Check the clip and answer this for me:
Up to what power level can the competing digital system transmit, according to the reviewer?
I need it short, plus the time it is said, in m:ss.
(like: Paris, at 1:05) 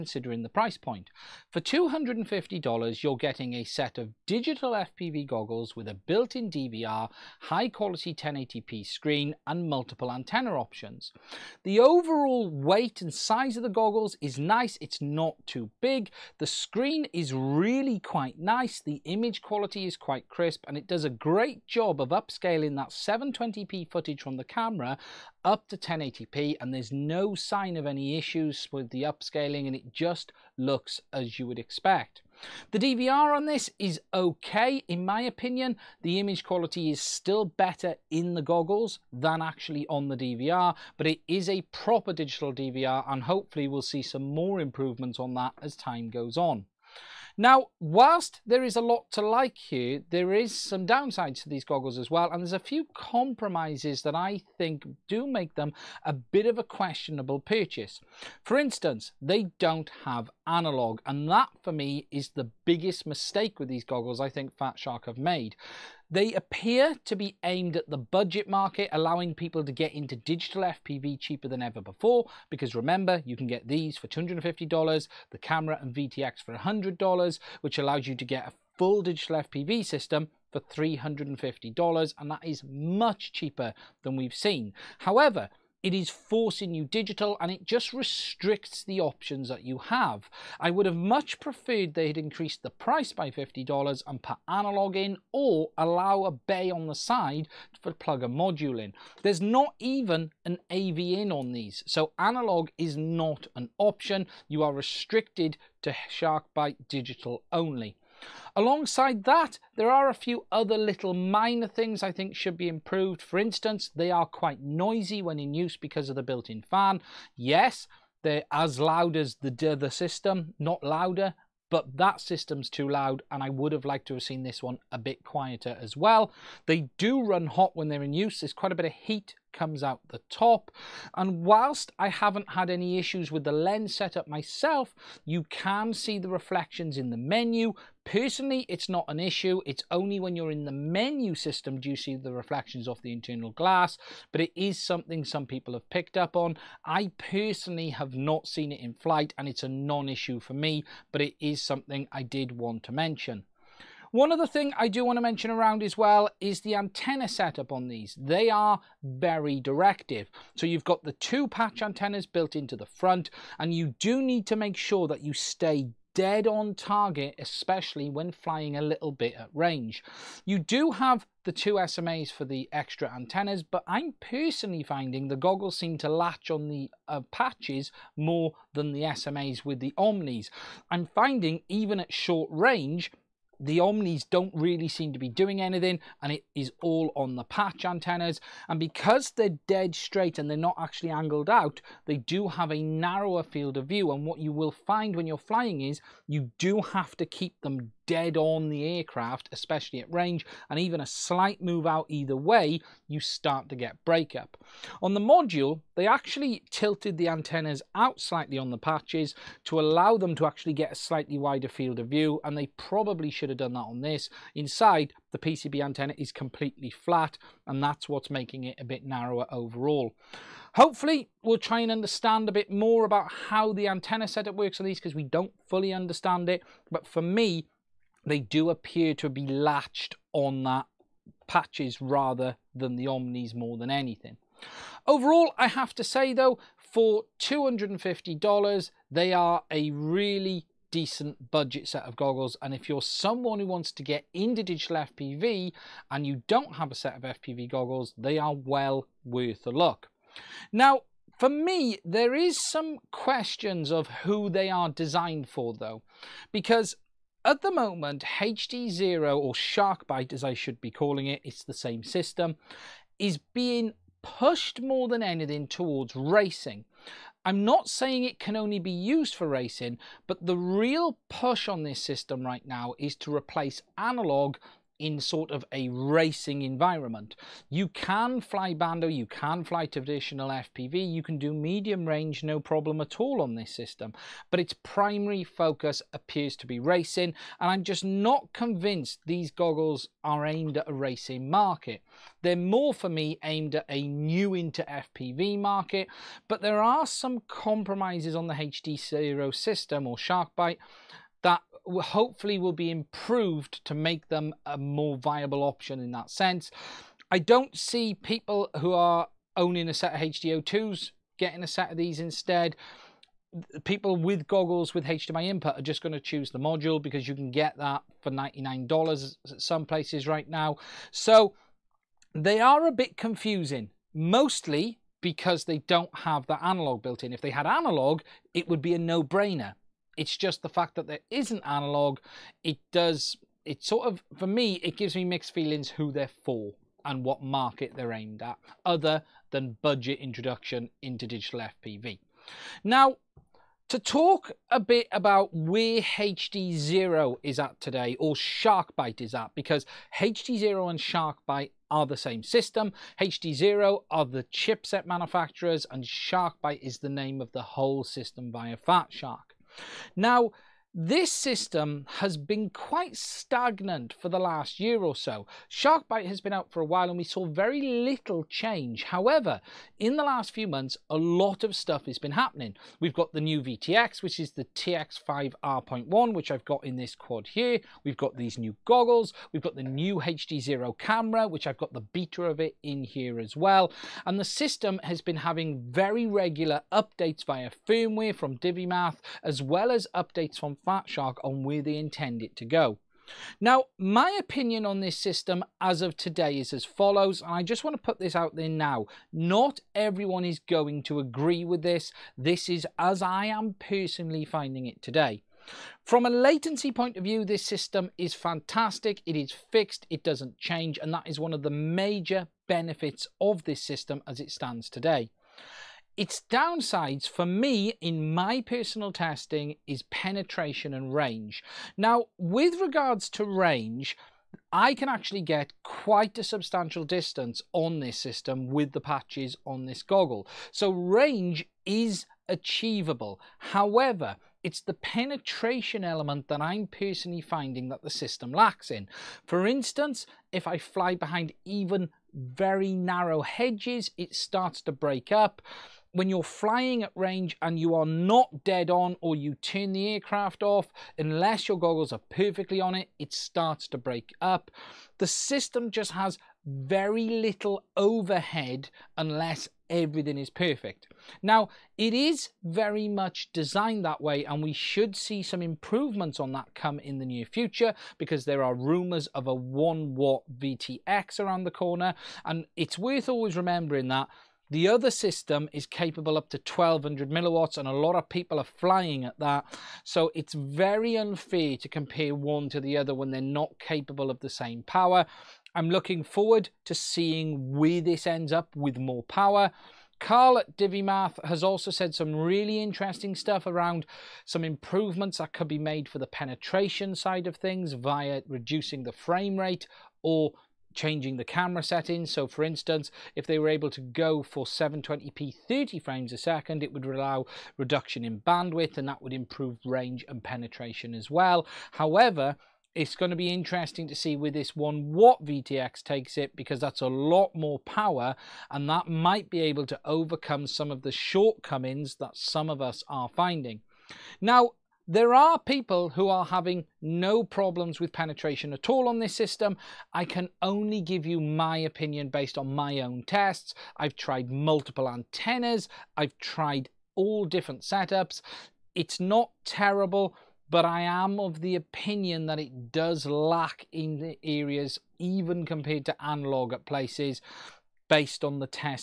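1200 milliwatts, at 7:56.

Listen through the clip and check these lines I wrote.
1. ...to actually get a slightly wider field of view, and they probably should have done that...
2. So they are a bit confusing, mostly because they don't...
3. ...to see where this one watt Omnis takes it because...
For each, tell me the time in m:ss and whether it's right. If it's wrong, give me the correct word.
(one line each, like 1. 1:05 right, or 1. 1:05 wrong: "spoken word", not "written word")
1. 3:30 right
2. 5:21 right
3. 8:34 wrong: "VTX", not "Omnis".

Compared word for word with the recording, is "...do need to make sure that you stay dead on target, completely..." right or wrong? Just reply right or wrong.
wrong.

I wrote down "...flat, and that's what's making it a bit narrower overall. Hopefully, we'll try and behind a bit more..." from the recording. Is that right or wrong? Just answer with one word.
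wrong.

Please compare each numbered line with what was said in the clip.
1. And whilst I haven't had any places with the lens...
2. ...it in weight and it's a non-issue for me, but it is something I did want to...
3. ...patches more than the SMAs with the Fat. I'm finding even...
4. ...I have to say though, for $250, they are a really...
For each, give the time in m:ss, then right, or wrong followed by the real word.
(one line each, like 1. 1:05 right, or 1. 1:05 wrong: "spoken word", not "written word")
1. 2:11 wrong: "issues", not "places"
2. 2:28 wrong: "flight", not "weight"
3. 2:57 wrong: "Omnis", not "Fat"
4. 3:55 right.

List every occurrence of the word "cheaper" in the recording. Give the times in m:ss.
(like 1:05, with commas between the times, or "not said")
1:11, 1:23.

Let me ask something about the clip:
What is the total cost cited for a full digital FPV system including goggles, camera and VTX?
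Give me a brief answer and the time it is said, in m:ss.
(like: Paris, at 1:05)
$350, at 1:20.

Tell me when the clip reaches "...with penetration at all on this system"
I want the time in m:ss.
8:47.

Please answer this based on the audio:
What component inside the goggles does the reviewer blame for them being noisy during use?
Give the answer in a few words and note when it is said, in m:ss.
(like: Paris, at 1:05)
built-in fan, at 1:56.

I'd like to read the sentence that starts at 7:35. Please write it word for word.
The system just has very little overhead unless everything is perfect.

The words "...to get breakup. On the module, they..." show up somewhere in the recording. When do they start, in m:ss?
3:23.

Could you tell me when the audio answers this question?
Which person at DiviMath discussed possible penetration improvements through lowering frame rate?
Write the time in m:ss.
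8:10.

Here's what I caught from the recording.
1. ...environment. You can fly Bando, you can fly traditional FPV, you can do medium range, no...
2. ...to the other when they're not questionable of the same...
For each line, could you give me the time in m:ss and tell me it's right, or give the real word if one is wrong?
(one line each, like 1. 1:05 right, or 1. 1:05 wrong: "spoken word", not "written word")
1. 4:36 right
2. 8:02 wrong: "capable", not "questionable".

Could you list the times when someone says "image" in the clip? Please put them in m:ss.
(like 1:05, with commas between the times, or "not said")
0:19, 0:36.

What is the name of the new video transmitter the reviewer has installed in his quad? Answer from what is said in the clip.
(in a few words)
TX5 R.1.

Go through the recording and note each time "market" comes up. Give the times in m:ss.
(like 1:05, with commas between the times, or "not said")
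1:08, 4:51, 4:55, 5:37.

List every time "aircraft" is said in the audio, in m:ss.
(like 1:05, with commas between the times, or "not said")
3:18, 7:30.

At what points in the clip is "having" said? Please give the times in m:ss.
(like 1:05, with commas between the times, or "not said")
6:25, 8:46.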